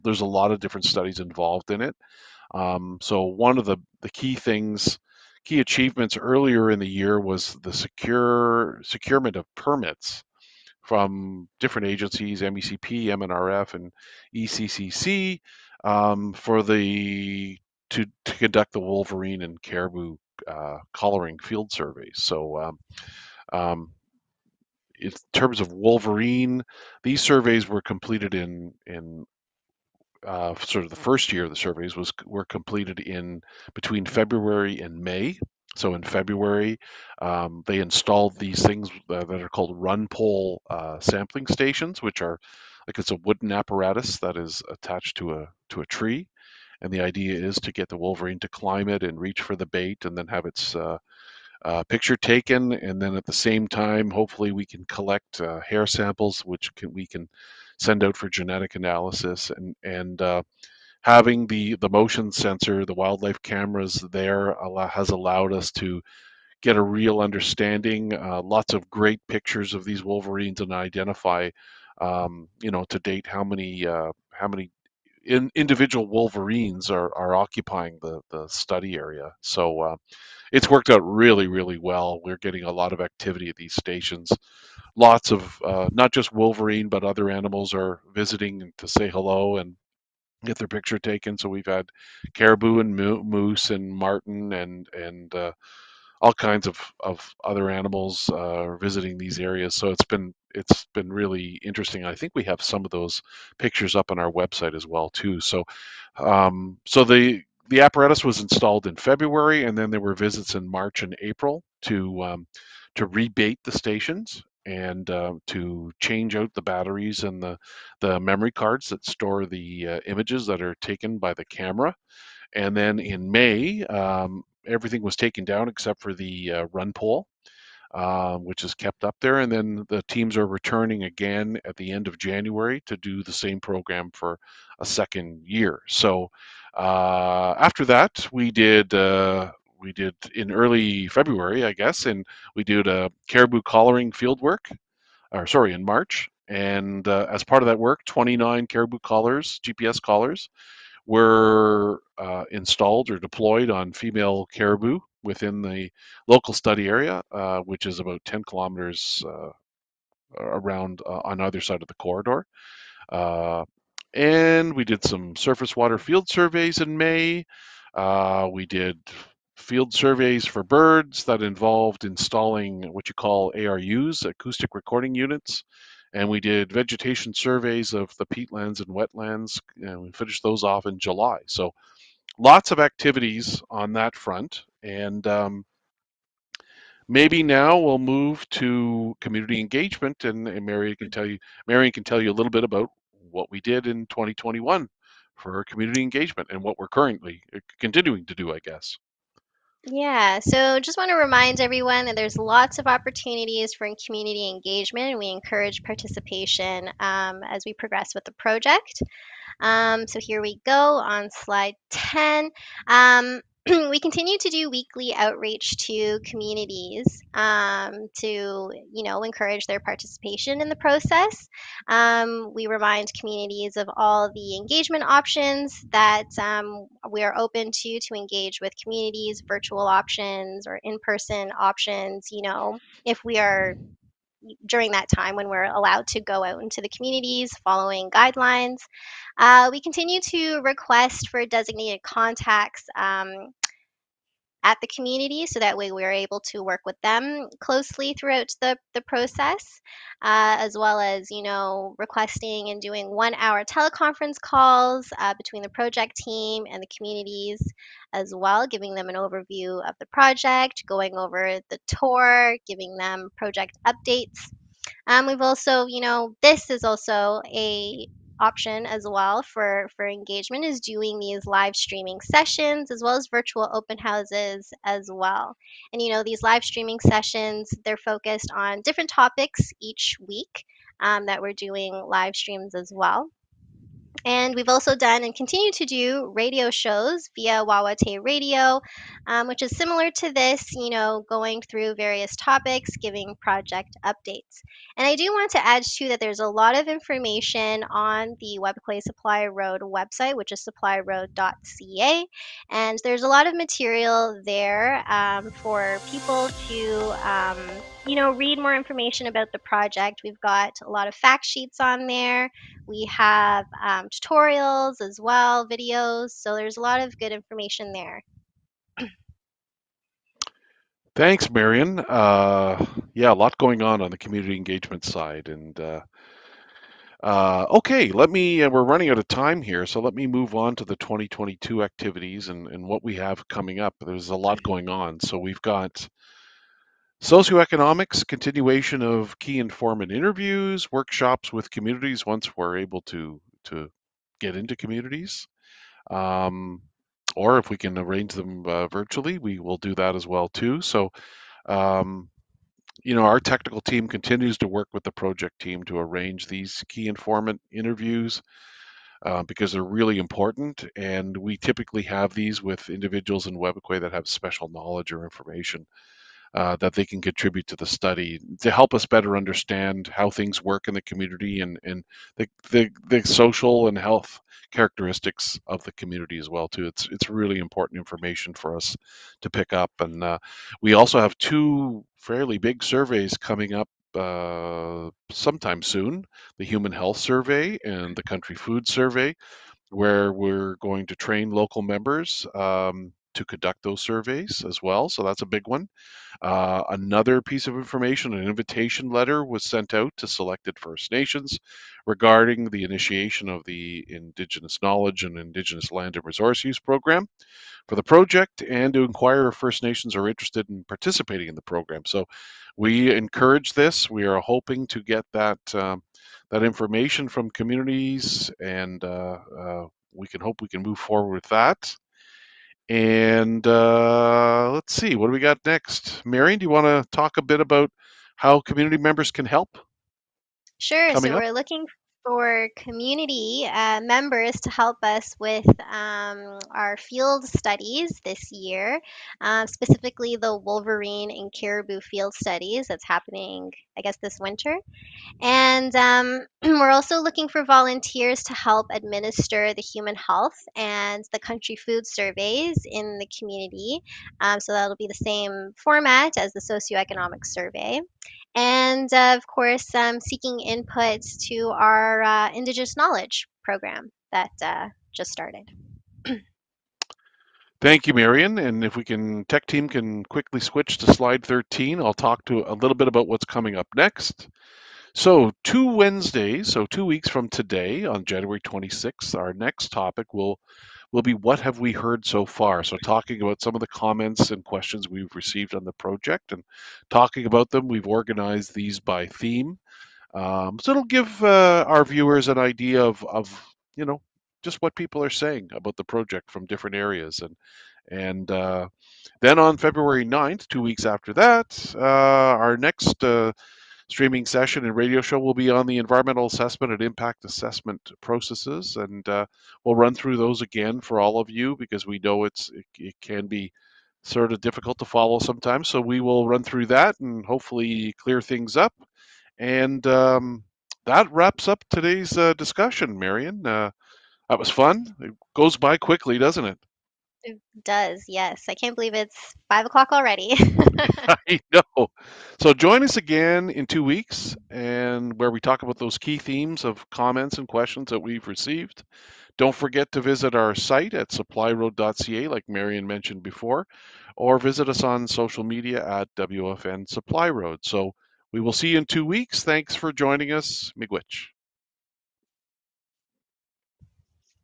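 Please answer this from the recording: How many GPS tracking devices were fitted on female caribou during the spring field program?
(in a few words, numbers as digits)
29.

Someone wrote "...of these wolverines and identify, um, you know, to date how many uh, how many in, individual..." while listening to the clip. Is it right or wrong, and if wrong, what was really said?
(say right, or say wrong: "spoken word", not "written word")
right.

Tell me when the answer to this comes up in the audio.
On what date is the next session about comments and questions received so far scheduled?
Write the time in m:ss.
7:58.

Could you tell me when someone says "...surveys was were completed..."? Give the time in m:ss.
0:31.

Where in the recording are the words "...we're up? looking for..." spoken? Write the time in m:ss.
7:11.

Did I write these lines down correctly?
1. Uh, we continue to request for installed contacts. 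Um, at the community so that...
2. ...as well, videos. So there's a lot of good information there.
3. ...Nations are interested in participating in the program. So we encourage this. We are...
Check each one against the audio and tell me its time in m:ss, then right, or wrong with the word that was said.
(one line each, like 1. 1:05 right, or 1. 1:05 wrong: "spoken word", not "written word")
1. 3:59 wrong: "designated", not "installed"
2. 5:15 right
3. 6:49 right.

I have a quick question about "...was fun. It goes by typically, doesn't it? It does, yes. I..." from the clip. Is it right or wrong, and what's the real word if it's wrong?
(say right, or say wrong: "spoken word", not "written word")
wrong: "quickly", not "typically".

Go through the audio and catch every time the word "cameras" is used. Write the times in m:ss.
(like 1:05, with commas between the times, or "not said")
1:03, 2:01.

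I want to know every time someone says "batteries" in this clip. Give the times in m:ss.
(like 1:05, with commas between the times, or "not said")
1:56.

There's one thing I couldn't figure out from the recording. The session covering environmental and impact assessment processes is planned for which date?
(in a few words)
February 9.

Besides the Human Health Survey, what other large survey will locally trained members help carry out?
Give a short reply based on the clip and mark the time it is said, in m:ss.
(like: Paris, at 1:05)
Country Food Survey, at 6:28.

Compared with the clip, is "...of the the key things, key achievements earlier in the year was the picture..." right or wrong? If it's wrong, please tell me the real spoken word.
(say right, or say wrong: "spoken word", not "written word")
wrong: "secure", not "picture".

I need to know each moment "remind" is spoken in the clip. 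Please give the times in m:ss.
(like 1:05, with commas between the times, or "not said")
3:21, 3:42.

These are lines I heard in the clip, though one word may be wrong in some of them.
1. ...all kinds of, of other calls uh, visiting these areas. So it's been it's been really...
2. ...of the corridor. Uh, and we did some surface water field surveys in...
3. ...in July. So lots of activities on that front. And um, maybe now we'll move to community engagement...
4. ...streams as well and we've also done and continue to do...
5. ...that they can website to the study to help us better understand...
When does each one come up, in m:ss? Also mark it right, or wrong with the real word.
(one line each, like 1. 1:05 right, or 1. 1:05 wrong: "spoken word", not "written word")
1. 1:36 wrong: "animals", not "calls"
2. 2:41 right
3. 3:00 right
4. 4:42 right
5. 6:06 wrong: "contribute", not "website".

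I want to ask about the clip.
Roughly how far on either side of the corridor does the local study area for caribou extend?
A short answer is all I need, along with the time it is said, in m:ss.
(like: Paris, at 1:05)
10 kilometers, at 2:38.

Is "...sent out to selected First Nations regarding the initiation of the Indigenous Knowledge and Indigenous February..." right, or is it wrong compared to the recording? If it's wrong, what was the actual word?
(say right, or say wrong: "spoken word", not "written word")
wrong: "Land", not "February".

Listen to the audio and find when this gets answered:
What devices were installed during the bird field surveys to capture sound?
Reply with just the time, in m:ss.
2:54.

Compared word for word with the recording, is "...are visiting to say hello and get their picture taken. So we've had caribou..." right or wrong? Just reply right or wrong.
right.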